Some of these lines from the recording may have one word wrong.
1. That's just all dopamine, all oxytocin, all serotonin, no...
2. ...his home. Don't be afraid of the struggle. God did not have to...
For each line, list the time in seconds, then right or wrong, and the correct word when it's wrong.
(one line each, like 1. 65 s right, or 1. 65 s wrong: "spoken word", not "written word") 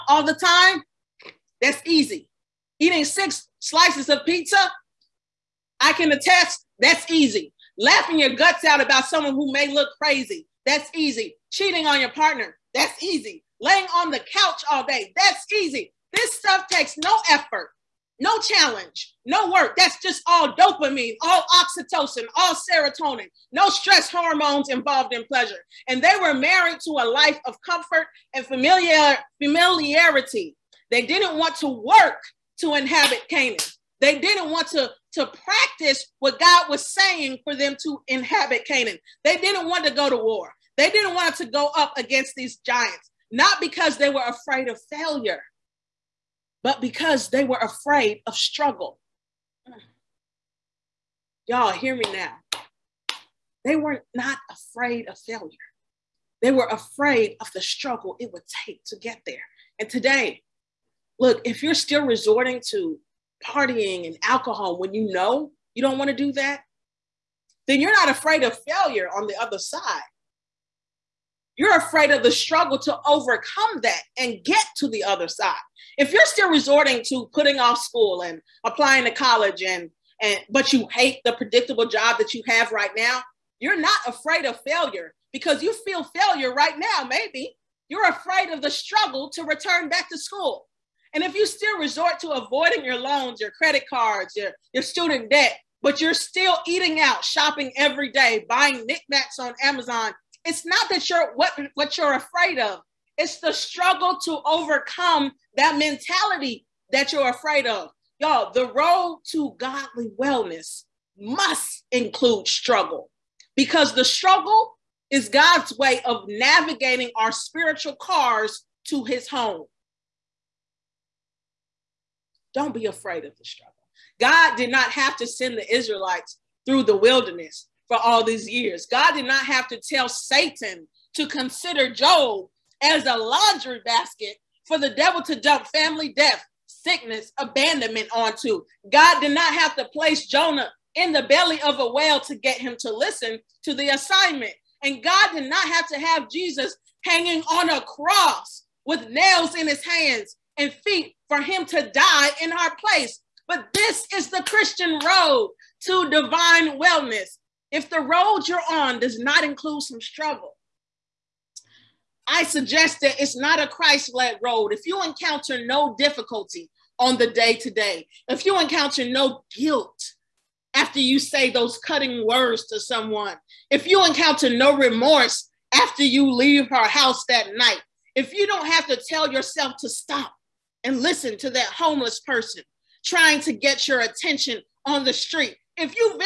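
1. 19 s right
2. 119 s right.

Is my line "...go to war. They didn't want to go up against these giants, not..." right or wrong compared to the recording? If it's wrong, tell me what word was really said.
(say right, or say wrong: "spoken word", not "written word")
right.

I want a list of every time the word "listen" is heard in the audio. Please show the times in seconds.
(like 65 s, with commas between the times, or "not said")
142 s, 181 s.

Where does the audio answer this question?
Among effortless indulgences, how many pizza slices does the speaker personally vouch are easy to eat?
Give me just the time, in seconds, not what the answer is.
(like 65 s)
3 s.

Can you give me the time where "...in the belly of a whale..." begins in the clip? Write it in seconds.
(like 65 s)
140 s.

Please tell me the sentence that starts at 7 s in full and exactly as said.
Laughing your guts out about someone who may look crazy, that's easy.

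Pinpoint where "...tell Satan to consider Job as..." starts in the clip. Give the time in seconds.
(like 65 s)
129 s.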